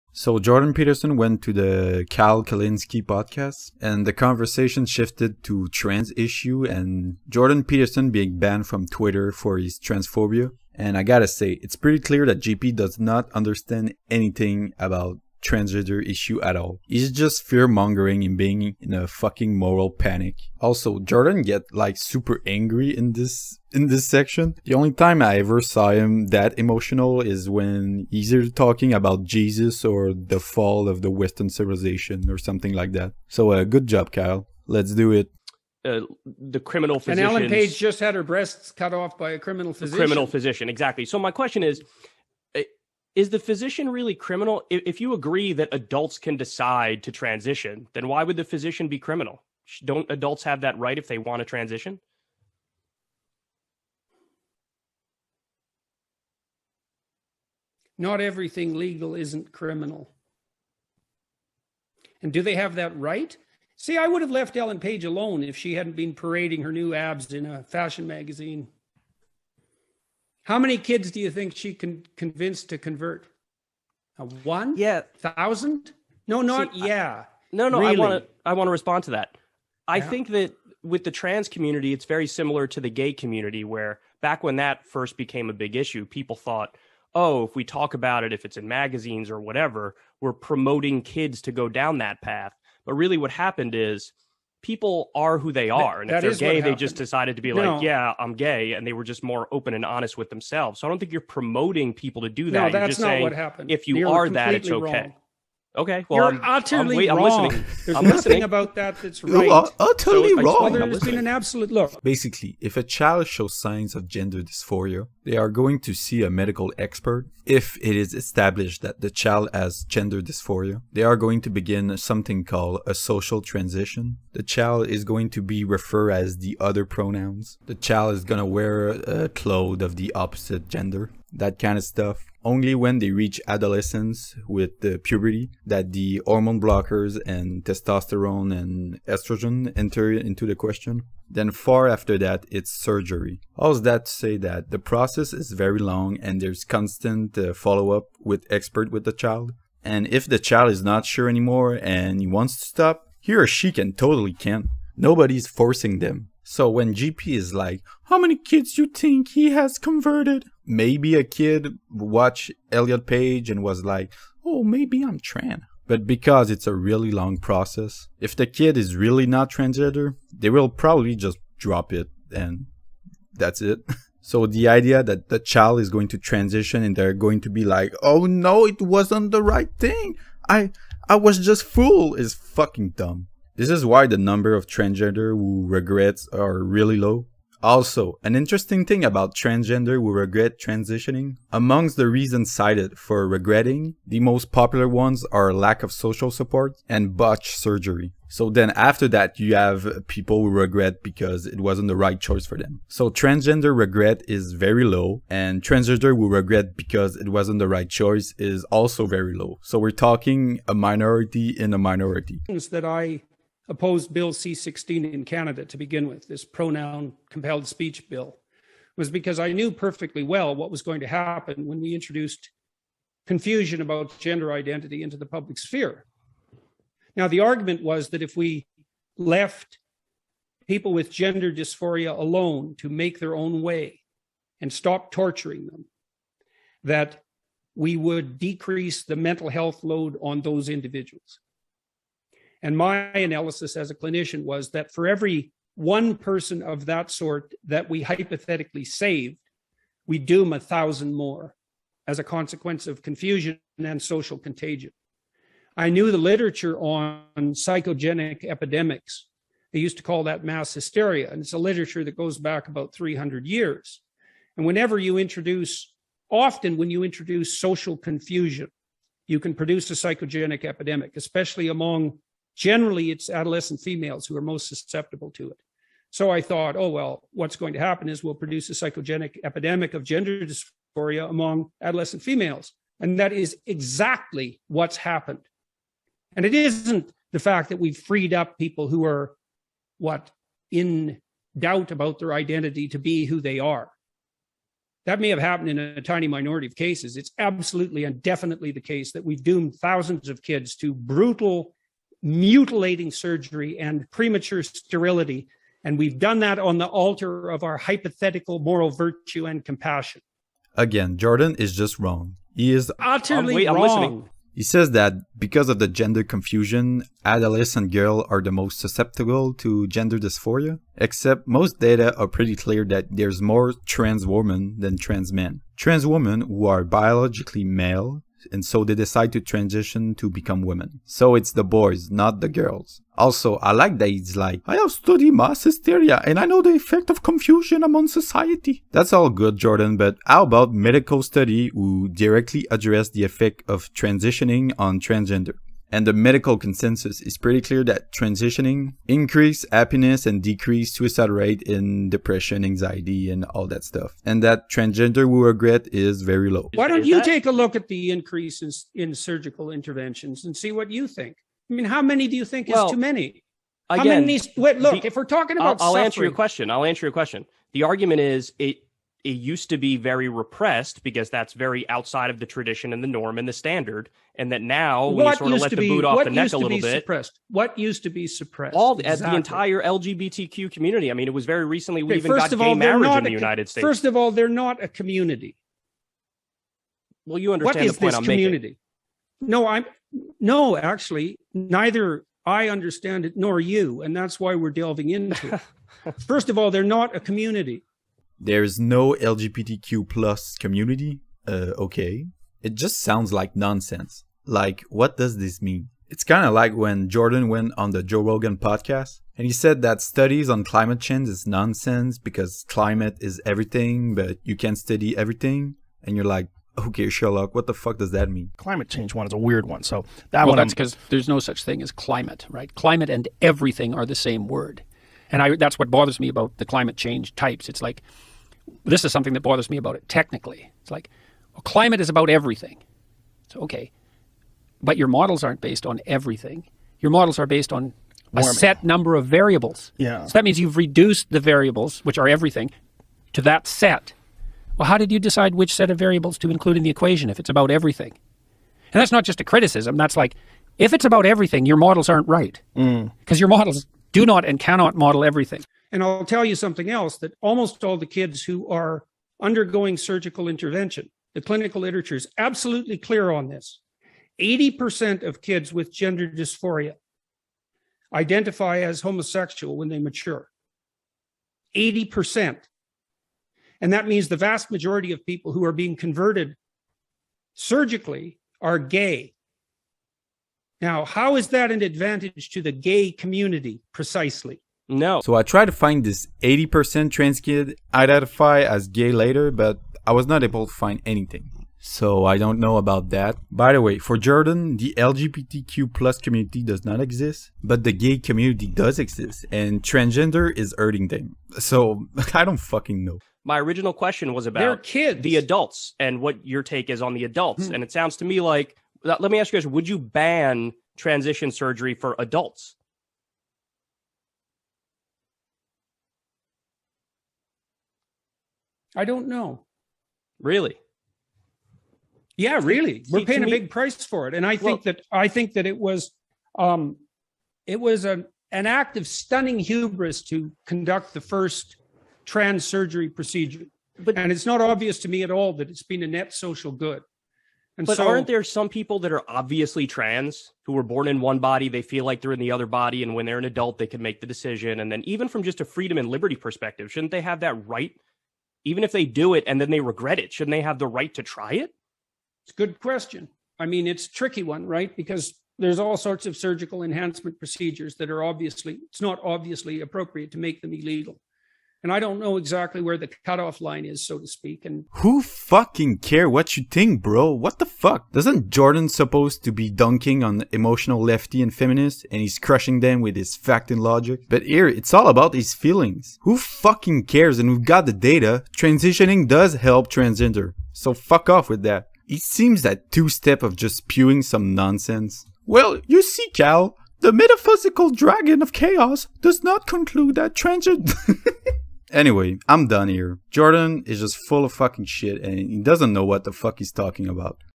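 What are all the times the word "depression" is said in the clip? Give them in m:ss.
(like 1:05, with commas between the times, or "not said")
5:52.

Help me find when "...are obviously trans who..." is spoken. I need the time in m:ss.
8:59.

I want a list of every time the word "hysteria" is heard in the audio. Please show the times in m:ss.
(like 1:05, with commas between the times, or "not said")
4:20, 5:35.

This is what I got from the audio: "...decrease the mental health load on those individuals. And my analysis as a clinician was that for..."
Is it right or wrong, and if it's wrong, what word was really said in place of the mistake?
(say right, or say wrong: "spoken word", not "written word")
right.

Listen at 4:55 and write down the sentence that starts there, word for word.
That may have happened in a tiny minority of cases.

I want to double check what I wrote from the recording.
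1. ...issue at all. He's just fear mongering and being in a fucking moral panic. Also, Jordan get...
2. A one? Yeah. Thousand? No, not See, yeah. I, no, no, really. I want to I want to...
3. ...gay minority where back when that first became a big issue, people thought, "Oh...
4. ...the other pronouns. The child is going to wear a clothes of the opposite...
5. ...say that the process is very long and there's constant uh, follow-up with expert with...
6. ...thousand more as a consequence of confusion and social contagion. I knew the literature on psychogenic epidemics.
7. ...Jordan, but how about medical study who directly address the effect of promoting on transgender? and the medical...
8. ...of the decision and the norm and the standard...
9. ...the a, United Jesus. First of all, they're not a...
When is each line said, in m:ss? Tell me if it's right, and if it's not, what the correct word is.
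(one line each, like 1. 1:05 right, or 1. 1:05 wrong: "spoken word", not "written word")
1. 0:16 right
2. 1:14 right
3. 1:22 wrong: "community", not "minority"
4. 2:06 right
5. 2:24 right
6. 4:10 right
7. 5:39 wrong: "transitioning", not "promoting"
8. 6:12 wrong: "tradition", not "decision"
9. 6:23 wrong: "States", not "Jesus".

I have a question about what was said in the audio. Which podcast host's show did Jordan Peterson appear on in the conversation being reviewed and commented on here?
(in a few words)
Kyle Kulinsky.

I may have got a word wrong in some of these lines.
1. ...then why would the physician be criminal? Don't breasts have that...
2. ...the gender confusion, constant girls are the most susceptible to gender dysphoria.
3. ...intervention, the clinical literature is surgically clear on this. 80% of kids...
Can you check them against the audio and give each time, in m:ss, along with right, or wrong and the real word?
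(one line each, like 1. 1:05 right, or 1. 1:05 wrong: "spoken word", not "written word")
1. 0:47 wrong: "adults", not "breasts"
2. 5:15 wrong: "adolescent", not "constant"
3. 7:40 wrong: "absolutely", not "surgically".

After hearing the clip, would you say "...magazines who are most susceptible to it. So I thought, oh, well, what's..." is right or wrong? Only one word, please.
wrong.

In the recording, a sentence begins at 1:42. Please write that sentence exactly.
No, that's not saying, what happened.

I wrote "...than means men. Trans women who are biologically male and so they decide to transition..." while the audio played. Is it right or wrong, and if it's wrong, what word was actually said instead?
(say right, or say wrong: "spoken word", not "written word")
wrong: "trans", not "means".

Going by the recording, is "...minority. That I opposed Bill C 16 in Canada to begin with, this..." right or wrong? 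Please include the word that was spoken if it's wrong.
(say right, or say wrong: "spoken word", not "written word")
right.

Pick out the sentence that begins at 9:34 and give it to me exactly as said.
But here, it's all about his feelings.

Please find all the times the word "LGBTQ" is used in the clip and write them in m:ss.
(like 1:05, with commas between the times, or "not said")
6:19, 6:39, 8:14.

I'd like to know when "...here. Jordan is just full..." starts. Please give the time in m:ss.
9:52.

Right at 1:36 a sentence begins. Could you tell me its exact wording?
And that if they're gay, they just decided to be no.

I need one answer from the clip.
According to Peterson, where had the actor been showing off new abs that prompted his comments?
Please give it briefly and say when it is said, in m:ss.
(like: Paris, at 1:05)
a fashion magazine, at 1:07.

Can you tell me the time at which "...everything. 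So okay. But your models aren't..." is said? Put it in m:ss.
7:12.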